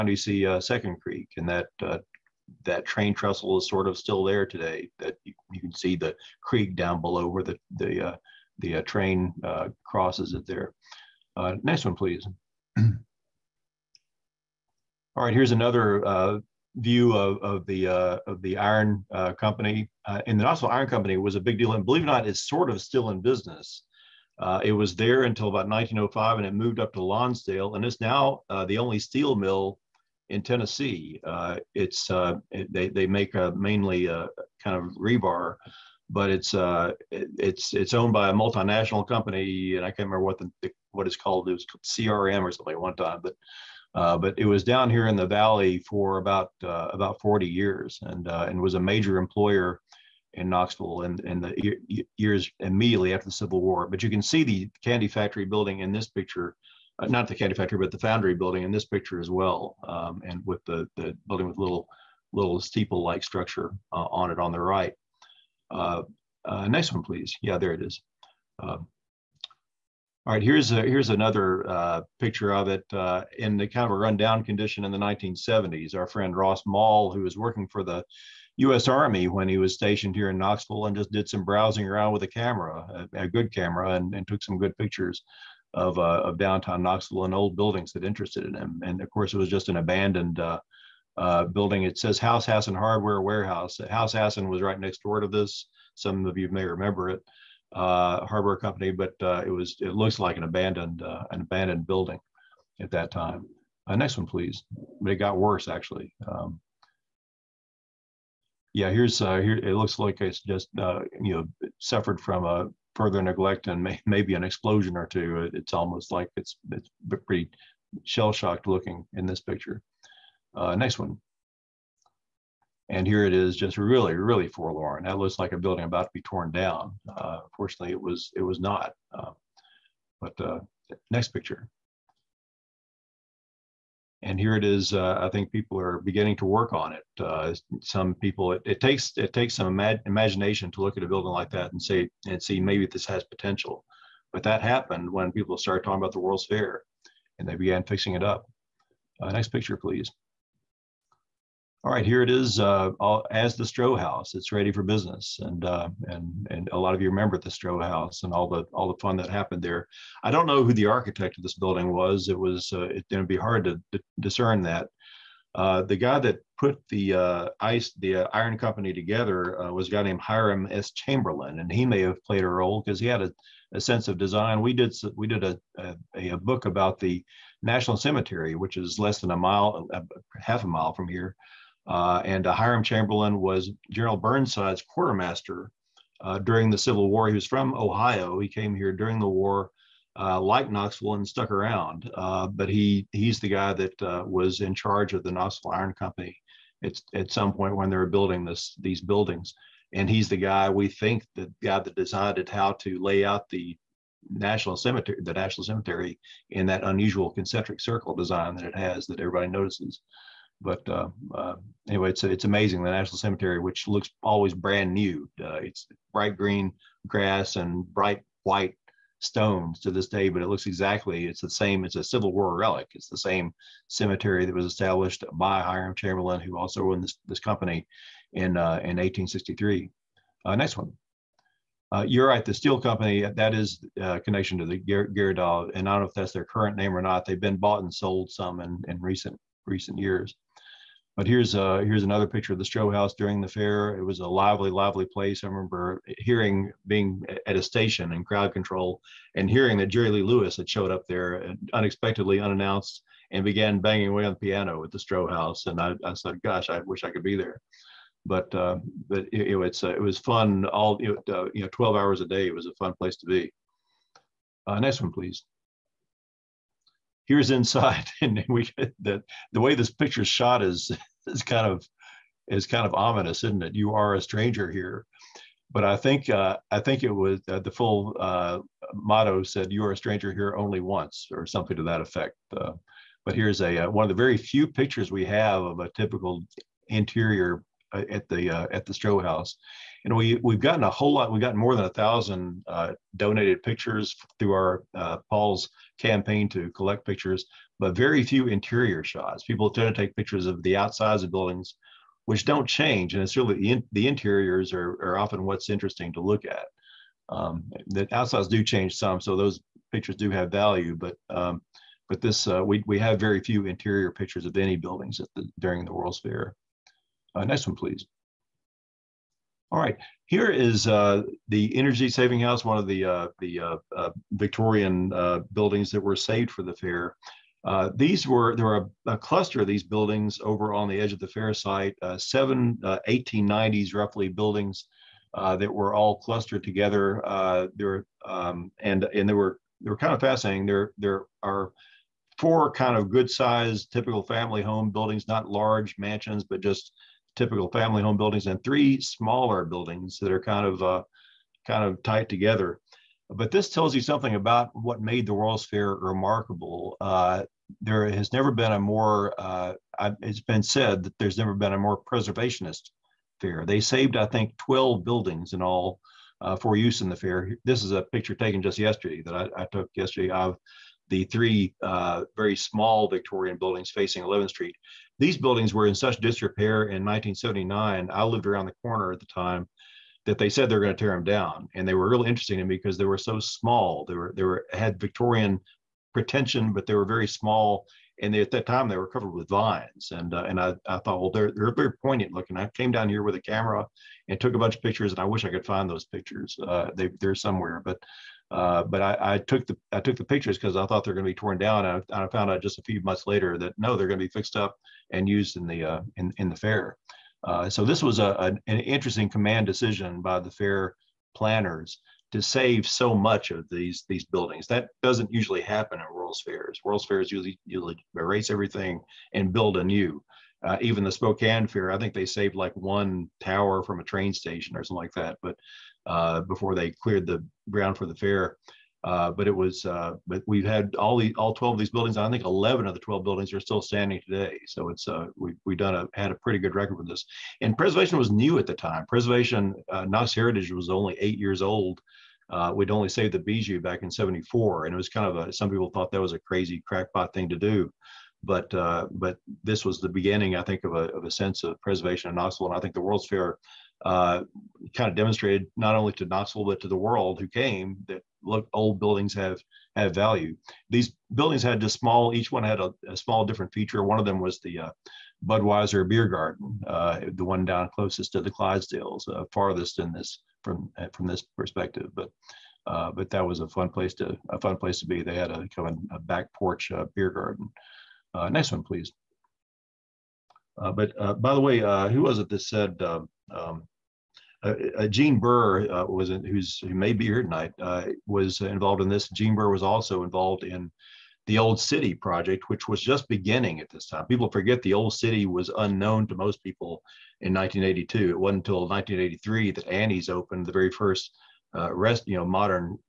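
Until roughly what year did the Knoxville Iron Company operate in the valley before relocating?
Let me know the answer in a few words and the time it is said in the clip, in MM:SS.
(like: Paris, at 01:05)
1905, at 00:25.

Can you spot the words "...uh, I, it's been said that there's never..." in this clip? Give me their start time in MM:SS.
05:59.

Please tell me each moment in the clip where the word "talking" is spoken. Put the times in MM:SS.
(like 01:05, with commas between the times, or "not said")
02:25.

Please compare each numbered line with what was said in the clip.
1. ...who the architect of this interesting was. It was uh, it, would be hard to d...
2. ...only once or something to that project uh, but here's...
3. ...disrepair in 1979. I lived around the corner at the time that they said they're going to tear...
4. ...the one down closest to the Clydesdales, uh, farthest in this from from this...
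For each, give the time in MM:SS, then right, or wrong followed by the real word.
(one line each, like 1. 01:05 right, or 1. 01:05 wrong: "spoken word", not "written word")
1. 02:40 wrong: "building", not "interesting"
2. 04:40 wrong: "effect", not "project"
3. 06:16 right
4. 07:47 right.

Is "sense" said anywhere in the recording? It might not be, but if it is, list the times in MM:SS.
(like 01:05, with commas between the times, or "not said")
02:53, 07:31.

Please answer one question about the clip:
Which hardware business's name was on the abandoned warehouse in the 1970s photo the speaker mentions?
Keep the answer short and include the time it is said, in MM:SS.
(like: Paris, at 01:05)
House Hasson Hardware, at 01:32.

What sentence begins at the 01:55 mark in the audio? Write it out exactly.
It, it's almost like it's it's pretty shell shocked looking in this picture.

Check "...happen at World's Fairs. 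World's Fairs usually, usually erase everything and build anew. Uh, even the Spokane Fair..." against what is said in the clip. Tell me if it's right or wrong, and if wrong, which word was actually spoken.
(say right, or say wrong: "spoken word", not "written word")
right.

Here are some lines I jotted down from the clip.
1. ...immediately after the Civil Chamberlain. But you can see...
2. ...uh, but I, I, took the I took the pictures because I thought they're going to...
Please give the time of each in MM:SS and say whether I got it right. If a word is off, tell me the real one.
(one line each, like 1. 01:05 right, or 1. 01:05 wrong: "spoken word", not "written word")
1. 00:52 wrong: "War", not "Chamberlain"
2. 06:38 right.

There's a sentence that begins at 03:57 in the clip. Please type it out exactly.
They've been bought and sold some in, in recent recent years.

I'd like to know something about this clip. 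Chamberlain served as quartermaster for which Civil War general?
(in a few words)
General Burnside.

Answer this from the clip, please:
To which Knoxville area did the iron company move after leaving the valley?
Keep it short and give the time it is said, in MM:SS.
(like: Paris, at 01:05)
Lonsdale, at 00:27.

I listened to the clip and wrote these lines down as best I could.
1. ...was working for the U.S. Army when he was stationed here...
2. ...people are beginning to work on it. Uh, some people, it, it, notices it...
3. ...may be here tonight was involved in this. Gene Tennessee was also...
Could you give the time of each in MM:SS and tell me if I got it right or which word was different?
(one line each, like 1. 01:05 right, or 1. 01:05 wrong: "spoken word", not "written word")
1. 01:17 right
2. 02:15 wrong: "takes", not "notices"
3. 08:06 wrong: "Burr", not "Tennessee".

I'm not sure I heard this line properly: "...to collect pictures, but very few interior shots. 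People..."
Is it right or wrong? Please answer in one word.
right.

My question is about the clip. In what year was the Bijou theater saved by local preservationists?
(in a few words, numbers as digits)
1974.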